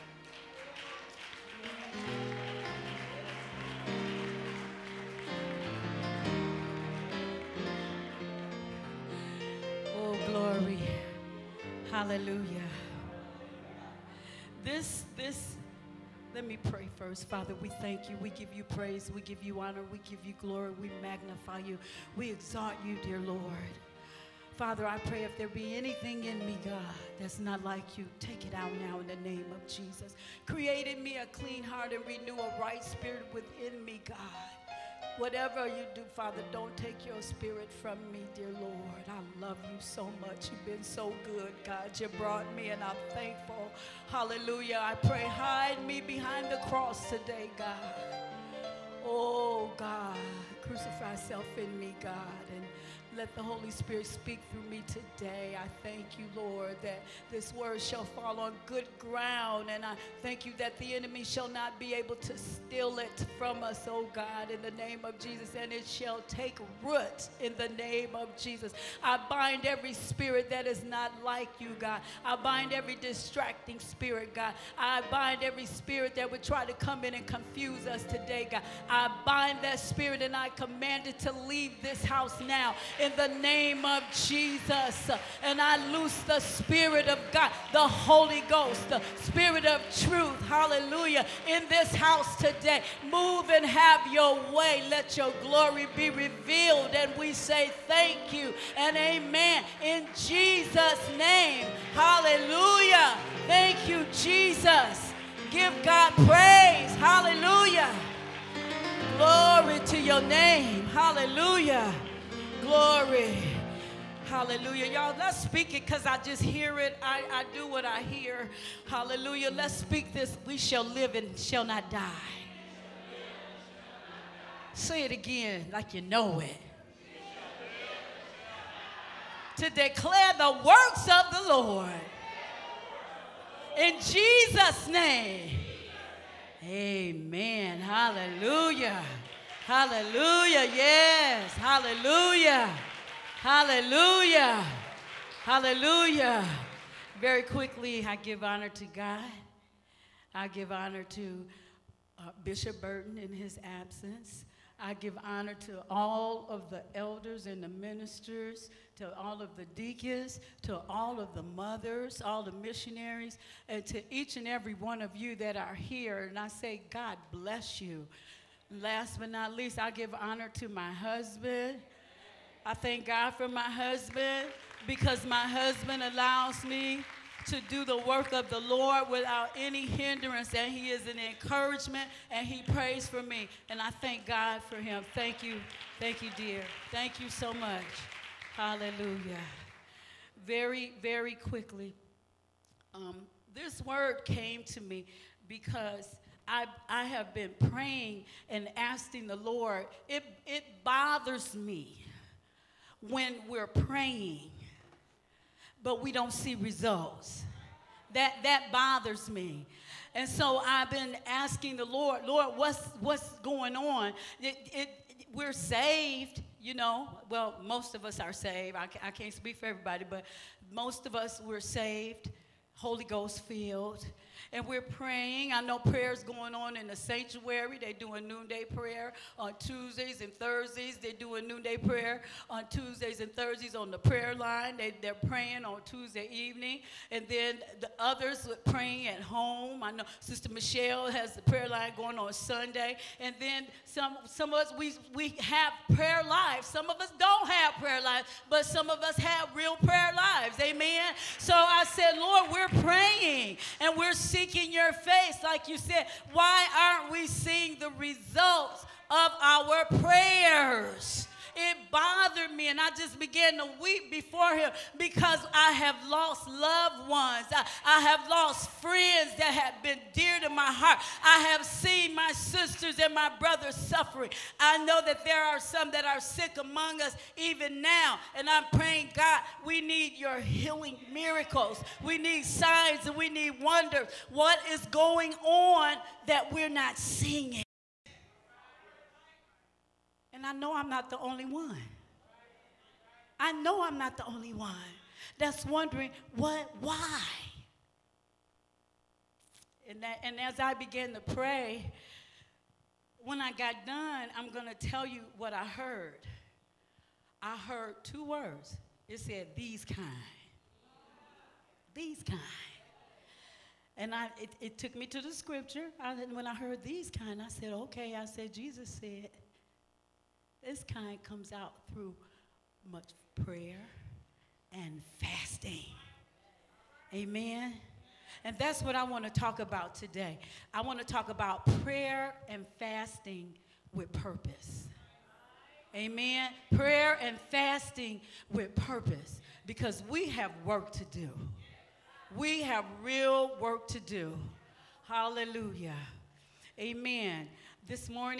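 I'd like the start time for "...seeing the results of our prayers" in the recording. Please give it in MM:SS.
04:17.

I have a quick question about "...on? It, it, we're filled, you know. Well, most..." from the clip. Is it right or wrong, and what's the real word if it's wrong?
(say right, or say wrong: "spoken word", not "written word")
wrong: "saved", not "filled".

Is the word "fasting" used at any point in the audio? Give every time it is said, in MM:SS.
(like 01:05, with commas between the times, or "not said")
05:25, 05:32, 05:37.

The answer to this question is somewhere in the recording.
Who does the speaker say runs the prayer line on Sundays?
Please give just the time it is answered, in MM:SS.
04:00.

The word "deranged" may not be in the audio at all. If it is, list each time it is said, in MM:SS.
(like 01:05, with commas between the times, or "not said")
not said.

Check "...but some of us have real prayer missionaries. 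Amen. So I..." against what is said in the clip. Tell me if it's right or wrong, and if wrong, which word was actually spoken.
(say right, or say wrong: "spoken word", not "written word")
wrong: "lives", not "missionaries".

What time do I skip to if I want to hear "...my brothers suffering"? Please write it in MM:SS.
04:33.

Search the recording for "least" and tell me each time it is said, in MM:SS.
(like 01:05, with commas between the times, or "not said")
02:49.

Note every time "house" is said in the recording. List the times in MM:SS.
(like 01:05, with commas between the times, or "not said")
01:22, 01:31.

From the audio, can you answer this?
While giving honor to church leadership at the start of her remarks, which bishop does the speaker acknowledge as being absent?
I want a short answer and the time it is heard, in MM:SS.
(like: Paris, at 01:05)
Bishop Burton, at 02:32.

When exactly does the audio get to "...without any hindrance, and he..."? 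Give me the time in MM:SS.
02:59.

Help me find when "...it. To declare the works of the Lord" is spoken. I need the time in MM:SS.
02:06.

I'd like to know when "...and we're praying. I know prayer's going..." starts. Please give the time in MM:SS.
03:44.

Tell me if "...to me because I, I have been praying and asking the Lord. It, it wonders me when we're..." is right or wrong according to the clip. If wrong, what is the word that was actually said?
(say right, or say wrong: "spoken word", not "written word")
wrong: "bothers", not "wonders".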